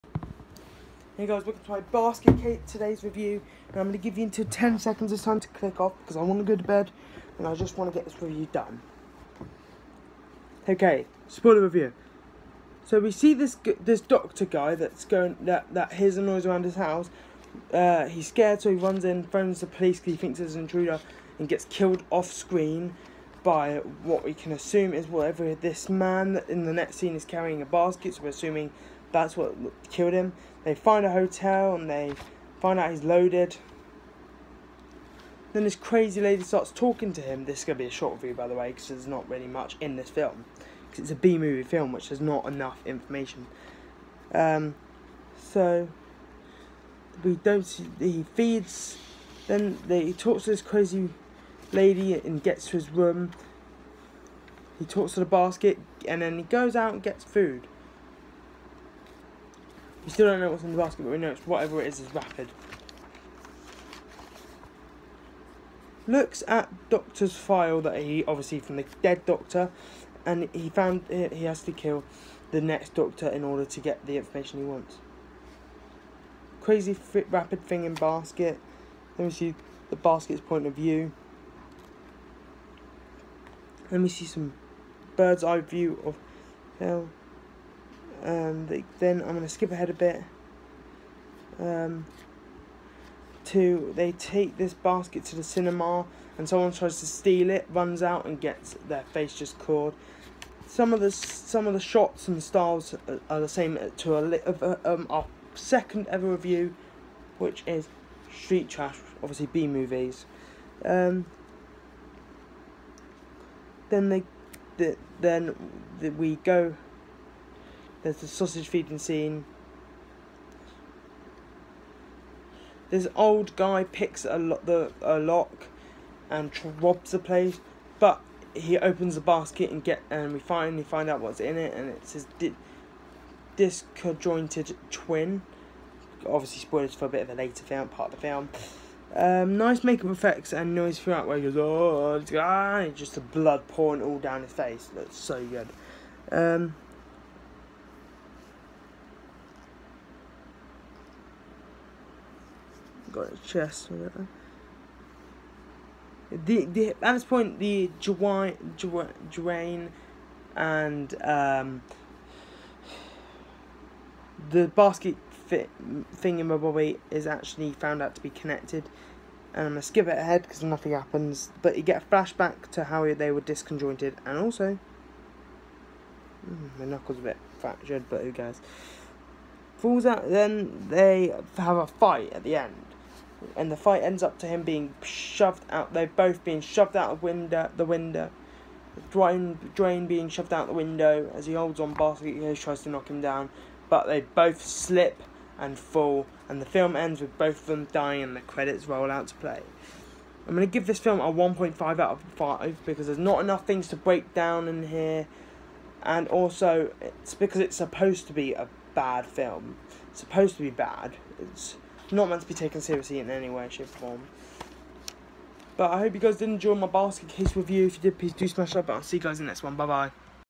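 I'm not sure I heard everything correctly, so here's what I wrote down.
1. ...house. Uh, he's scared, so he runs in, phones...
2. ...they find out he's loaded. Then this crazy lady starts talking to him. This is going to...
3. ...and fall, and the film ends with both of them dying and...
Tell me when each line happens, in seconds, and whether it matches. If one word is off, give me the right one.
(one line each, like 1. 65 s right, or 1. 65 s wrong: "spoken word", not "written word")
1. 16 s right
2. 31 s right
3. 195 s right.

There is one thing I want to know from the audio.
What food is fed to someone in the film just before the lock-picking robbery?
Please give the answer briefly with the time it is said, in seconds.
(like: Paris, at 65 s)
sausage, at 118 s.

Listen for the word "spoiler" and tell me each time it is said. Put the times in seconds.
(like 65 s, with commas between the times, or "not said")
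11 s, 136 s.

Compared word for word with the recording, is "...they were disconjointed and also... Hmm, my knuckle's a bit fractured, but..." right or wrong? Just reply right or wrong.
right.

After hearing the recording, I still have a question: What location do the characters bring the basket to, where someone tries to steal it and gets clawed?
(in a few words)
the cinema.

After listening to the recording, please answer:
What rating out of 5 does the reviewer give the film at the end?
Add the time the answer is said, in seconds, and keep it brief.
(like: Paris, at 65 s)
1.5, at 201 s.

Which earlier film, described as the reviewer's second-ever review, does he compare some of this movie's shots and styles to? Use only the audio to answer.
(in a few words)
Street Trash.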